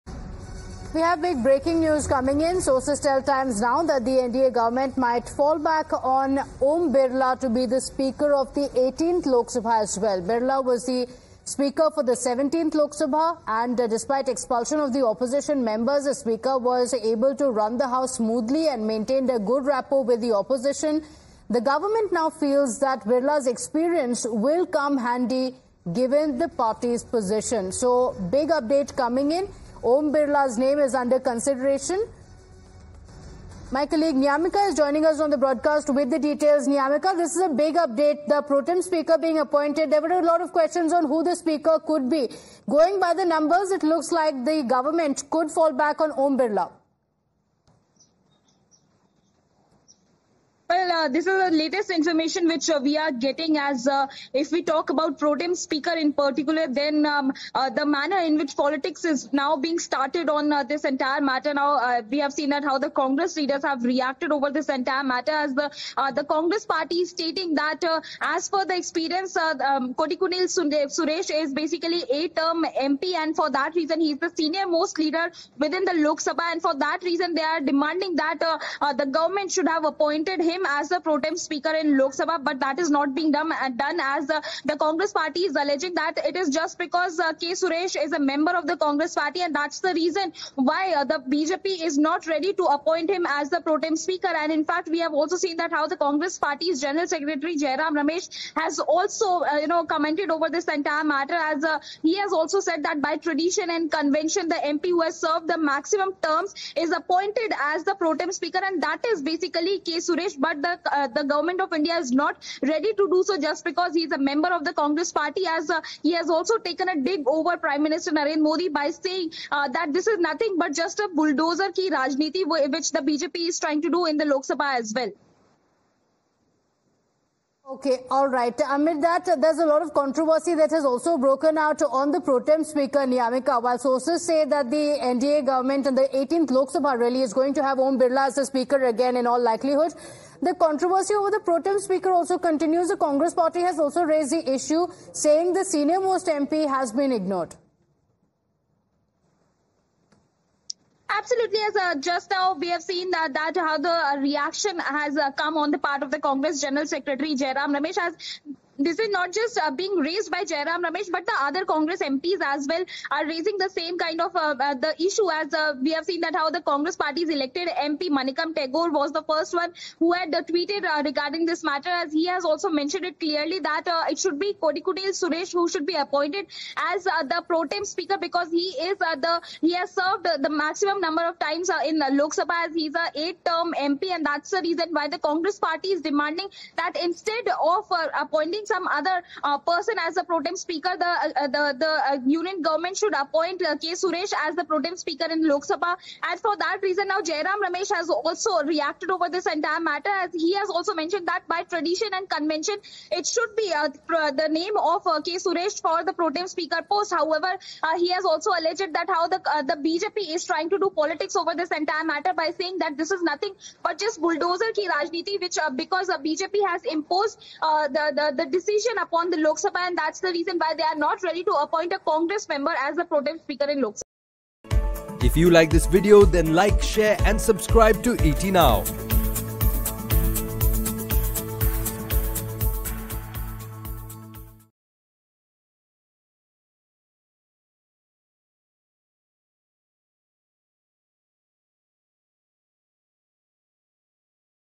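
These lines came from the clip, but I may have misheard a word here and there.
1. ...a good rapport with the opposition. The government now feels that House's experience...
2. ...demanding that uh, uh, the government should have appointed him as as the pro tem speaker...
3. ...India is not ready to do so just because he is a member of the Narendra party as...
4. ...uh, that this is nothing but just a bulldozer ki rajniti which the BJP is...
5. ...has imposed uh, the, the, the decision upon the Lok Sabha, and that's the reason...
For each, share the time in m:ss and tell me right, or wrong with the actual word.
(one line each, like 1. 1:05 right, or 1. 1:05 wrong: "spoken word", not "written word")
1. 0:19 wrong: "Birla", not "House"
2. 1:17 right
3. 1:51 wrong: "Congress", not "Narendra"
4. 1:59 right
5. 3:36 right.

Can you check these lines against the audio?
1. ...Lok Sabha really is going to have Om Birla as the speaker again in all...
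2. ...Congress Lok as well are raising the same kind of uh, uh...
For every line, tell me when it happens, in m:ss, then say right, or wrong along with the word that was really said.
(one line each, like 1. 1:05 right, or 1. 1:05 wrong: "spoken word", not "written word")
1. 2:16 right
2. 2:41 wrong: "MPs", not "Lok".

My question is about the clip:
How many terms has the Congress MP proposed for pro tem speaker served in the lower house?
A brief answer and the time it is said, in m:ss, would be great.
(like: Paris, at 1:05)
8, at 3:03.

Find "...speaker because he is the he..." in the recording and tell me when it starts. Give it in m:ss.
2:57.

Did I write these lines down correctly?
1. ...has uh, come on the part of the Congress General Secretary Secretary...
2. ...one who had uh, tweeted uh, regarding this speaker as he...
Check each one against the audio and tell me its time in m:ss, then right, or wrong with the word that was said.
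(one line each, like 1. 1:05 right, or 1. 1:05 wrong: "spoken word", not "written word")
1. 2:34 wrong: "Jairam", not "Secretary"
2. 2:49 wrong: "matter", not "speaker".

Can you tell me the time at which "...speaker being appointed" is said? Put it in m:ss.
0:38.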